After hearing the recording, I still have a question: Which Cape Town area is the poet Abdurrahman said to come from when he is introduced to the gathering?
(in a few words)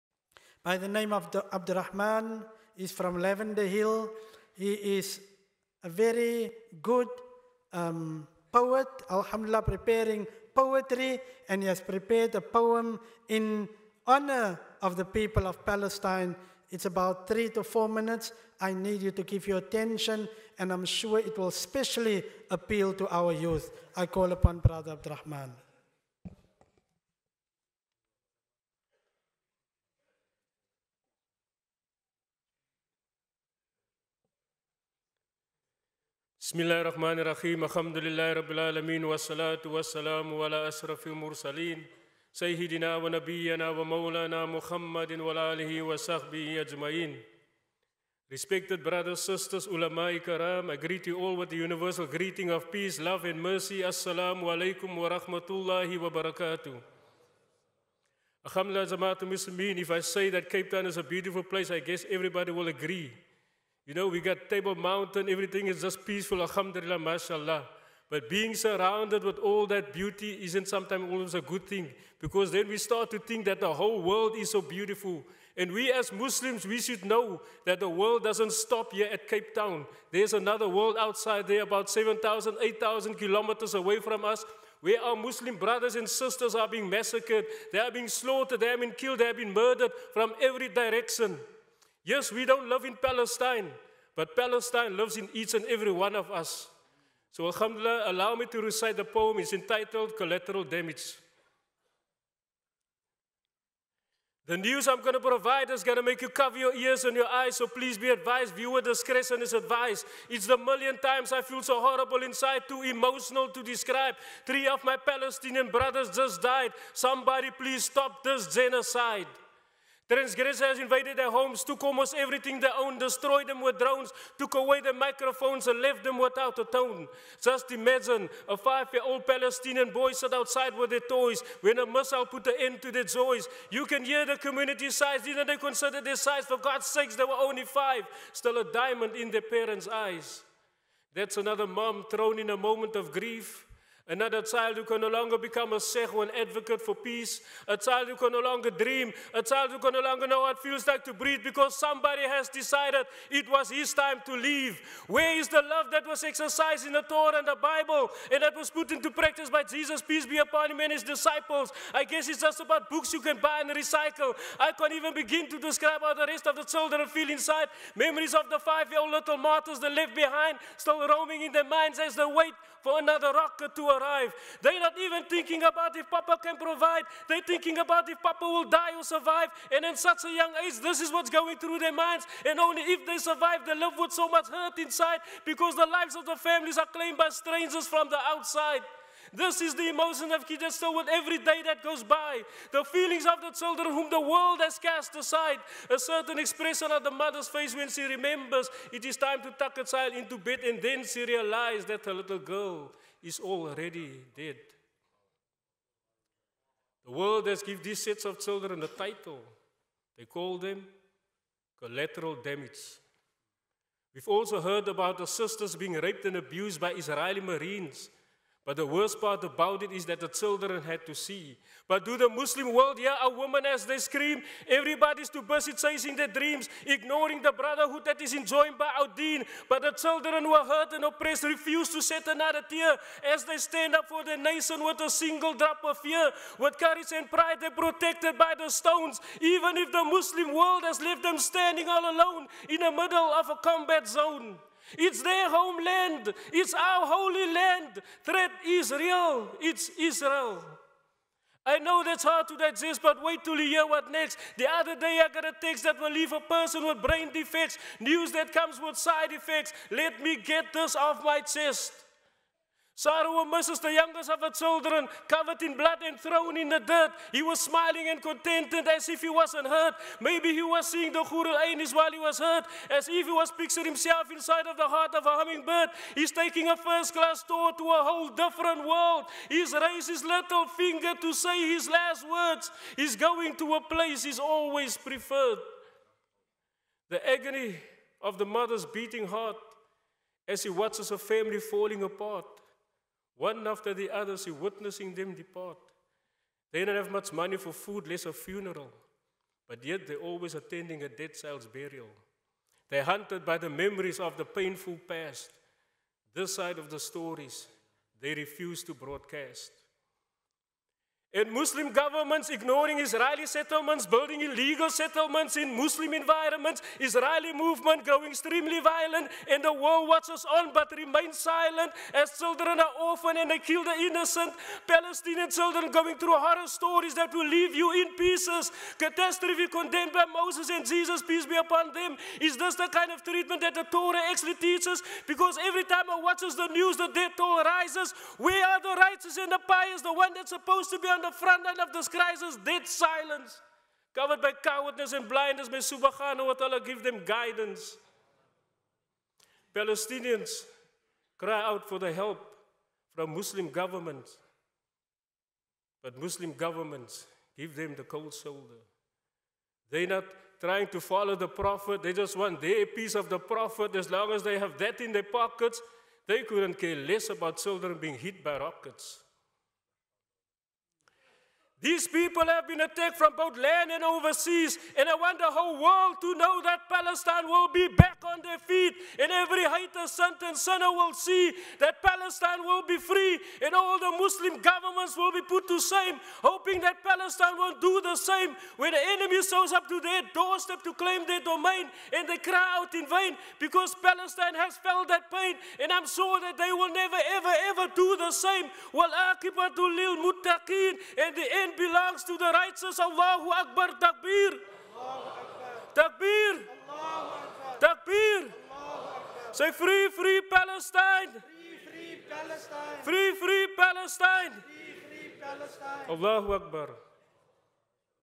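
Lavender Hill.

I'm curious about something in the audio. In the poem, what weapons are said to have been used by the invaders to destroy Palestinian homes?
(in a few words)
drones.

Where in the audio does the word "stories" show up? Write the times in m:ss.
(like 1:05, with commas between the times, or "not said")
5:06, 5:26.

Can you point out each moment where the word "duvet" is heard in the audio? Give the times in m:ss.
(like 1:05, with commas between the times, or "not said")
not said.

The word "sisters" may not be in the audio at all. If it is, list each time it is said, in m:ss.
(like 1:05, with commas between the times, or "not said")
0:49, 1:26, 3:35.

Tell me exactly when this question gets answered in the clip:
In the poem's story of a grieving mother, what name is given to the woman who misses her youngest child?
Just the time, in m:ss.
4:22.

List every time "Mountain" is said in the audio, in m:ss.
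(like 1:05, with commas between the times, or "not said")
1:04.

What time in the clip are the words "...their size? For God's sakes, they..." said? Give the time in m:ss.
2:16.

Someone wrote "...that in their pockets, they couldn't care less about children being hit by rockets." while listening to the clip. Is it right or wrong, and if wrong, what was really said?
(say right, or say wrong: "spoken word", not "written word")
right.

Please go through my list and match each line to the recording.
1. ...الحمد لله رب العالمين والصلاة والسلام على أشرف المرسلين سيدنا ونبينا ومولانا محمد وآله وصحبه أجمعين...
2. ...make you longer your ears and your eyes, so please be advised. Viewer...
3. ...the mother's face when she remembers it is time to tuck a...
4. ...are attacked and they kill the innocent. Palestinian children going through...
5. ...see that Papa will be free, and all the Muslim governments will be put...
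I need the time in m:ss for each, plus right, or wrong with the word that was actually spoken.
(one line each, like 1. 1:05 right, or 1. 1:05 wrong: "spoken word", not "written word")
1. 0:37 right
2. 1:46 wrong: "cover", not "longer"
3. 3:17 right
4. 5:22 wrong: "orphaned", not "attacked"
5. 6:21 wrong: "Palestine", not "Papa".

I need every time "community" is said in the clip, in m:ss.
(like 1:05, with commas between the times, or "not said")
2:14.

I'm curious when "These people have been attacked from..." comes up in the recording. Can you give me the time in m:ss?
6:11.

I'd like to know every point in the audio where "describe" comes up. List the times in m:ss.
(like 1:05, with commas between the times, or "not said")
1:53, 2:45.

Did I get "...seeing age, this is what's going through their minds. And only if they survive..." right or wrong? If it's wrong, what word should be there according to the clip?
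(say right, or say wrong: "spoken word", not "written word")
wrong: "young", not "seeing".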